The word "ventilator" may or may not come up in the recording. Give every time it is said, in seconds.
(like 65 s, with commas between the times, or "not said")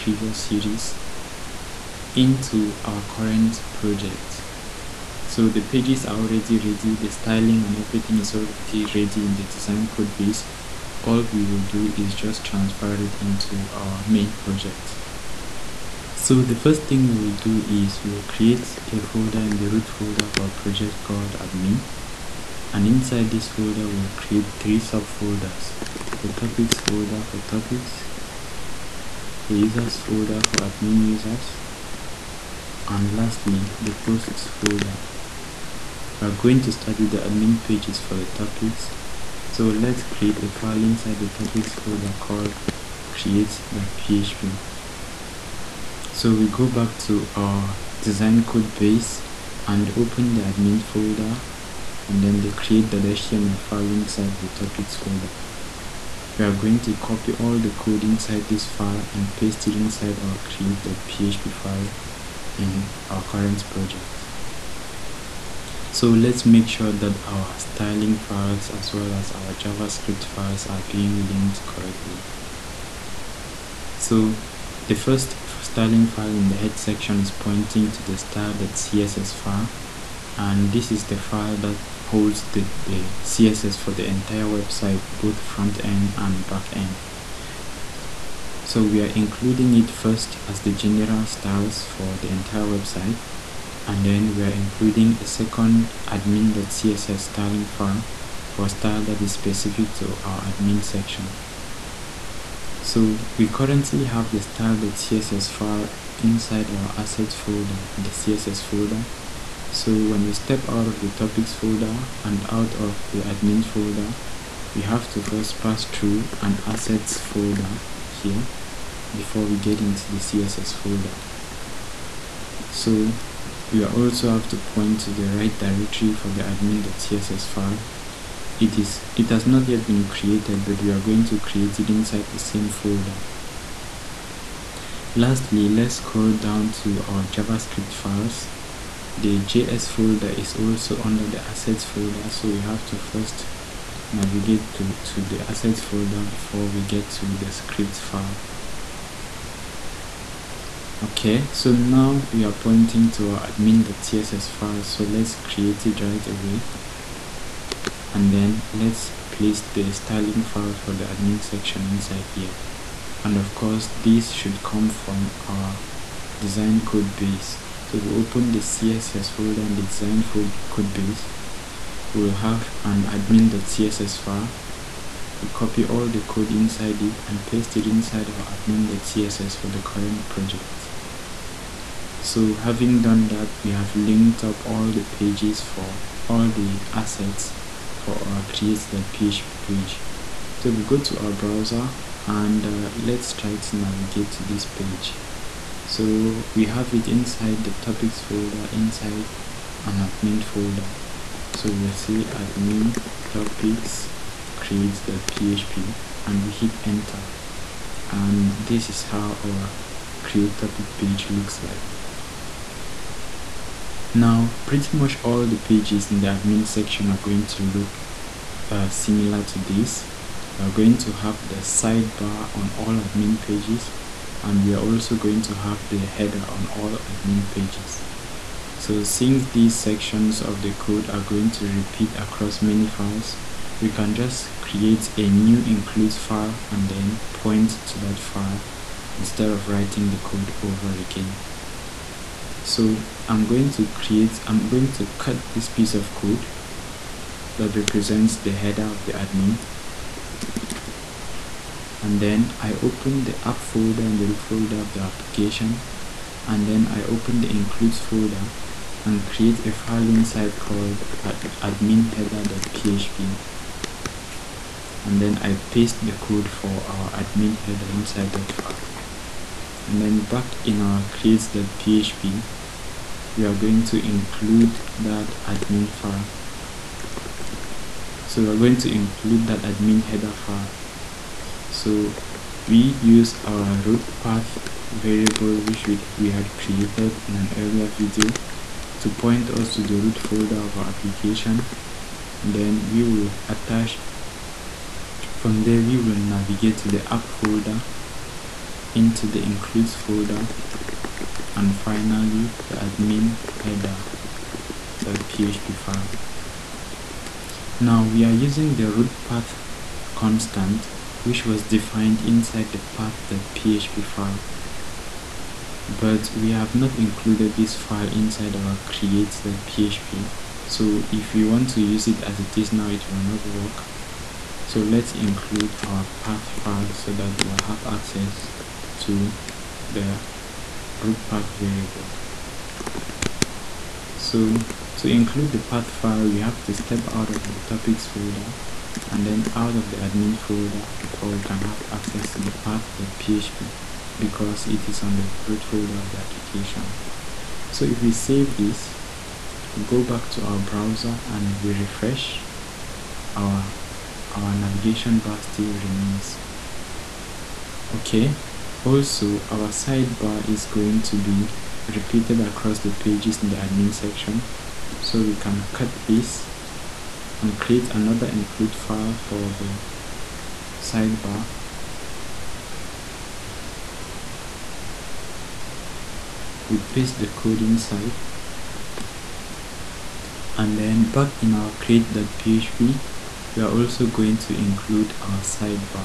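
not said.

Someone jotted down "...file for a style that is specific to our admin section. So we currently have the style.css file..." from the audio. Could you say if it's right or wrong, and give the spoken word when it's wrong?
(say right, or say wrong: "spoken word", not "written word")
right.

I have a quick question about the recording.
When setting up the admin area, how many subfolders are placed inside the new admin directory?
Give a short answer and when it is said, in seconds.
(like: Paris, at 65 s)
3, at 24 s.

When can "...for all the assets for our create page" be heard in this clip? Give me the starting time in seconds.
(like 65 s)
185 s.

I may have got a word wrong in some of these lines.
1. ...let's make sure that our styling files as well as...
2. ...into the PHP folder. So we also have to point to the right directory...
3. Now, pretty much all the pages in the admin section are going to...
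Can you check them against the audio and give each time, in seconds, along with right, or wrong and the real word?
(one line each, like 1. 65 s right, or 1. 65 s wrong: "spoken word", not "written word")
1. 66 s right
2. 119 s wrong: "CSS", not "PHP"
3. 214 s right.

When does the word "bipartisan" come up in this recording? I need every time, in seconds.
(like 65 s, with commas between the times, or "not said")
not said.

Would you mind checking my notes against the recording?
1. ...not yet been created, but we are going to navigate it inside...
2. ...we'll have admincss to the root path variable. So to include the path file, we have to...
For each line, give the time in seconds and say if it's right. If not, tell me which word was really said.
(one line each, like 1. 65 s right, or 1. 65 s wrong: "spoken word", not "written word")
1. 129 s wrong: "create", not "navigate"
2. 327 s wrong: "access", not "admincss".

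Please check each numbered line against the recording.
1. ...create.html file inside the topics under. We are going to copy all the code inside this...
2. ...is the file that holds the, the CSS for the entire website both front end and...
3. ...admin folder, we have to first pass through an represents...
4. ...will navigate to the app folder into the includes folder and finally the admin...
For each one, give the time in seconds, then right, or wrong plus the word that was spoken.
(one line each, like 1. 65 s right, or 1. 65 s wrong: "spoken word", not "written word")
1. 52 s wrong: "folder", not "under"
2. 80 s right
3. 113 s wrong: "assets", not "represents"
4. 295 s right.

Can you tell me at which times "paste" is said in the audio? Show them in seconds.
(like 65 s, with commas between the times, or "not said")
59 s, 177 s, 265 s, 376 s.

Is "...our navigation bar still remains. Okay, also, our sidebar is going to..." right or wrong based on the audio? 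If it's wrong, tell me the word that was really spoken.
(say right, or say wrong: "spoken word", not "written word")
right.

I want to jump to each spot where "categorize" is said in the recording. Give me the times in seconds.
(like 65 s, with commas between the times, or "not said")
not said.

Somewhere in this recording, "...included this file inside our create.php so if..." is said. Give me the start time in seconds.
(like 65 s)
316 s.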